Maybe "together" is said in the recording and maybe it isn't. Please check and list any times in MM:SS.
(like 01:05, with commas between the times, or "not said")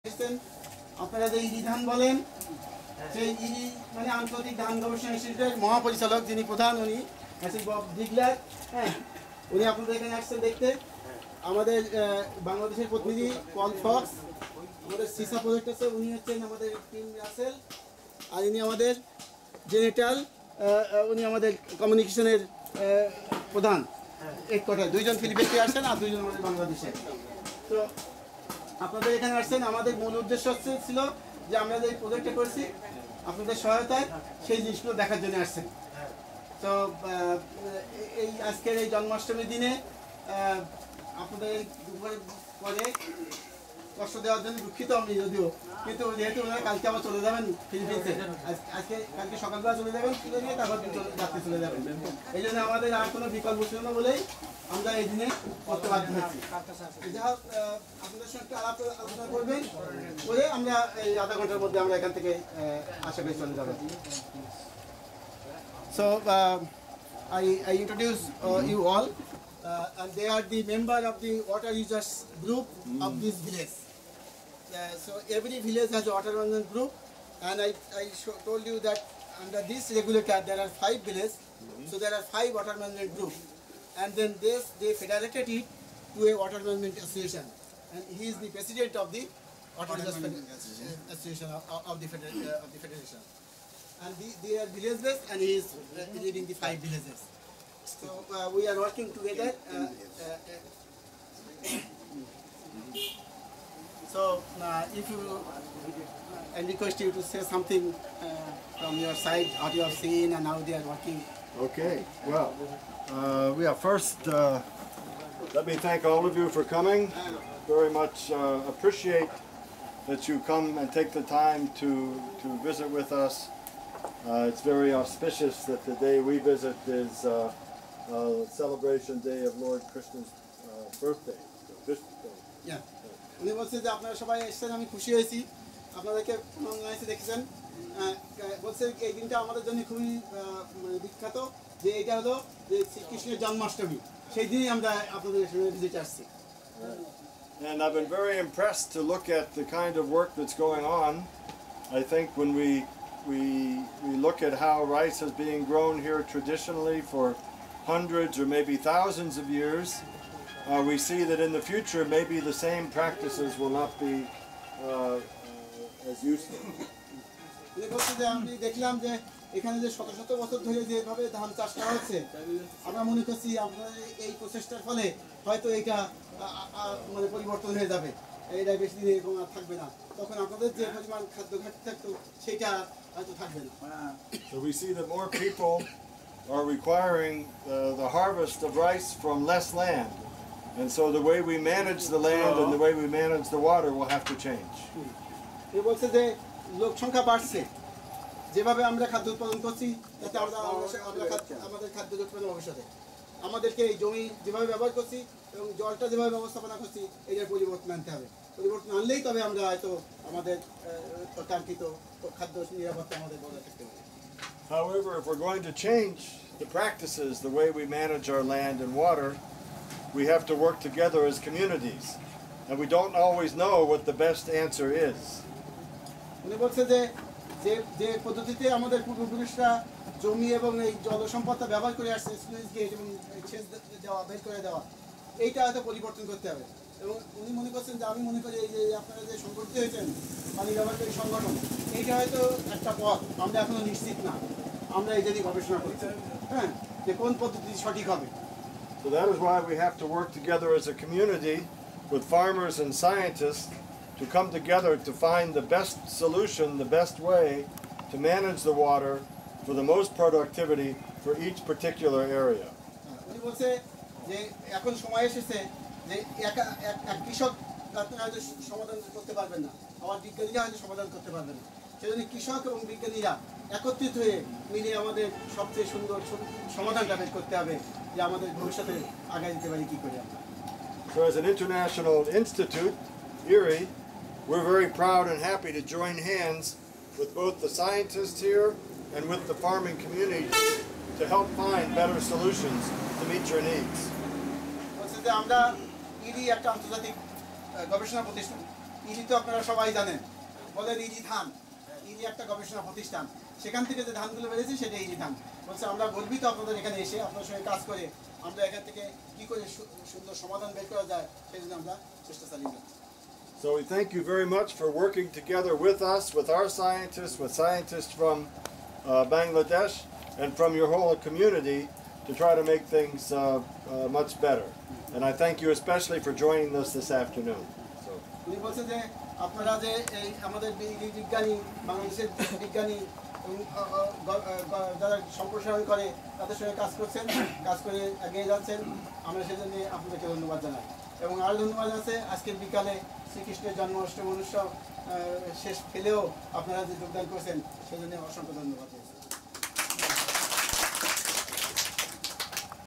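01:39, 04:10, 04:14, 05:15.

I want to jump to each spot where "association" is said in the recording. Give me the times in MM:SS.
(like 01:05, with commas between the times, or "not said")
01:26, 01:31.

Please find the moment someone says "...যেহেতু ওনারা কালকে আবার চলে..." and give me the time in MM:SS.
00:46.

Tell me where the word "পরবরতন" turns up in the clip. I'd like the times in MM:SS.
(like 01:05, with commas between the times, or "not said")
03:55.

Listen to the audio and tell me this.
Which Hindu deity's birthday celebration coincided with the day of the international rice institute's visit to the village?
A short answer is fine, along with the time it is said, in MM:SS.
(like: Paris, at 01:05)
Lord Krishna, at 02:09.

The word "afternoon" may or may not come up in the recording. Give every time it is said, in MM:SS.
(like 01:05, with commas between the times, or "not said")
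05:27.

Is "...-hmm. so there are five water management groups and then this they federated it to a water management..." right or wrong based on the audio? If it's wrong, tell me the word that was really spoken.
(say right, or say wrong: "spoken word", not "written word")
right.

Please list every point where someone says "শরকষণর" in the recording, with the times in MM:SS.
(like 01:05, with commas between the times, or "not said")
02:22, 05:43.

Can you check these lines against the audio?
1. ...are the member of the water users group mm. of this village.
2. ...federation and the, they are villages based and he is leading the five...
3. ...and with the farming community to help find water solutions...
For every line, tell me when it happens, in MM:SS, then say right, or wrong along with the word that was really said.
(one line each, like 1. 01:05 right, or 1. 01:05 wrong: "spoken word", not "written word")
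1. 01:10 right
2. 01:32 right
3. 04:49 wrong: "better", not "water".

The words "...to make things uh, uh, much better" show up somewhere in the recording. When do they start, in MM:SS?
05:22.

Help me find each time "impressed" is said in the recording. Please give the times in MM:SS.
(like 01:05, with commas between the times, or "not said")
02:28.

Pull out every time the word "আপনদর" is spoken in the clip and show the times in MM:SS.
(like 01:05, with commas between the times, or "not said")
00:09, 00:28, 00:33, 00:41, 02:25, 05:06.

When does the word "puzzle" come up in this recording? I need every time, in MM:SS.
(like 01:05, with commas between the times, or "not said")
not said.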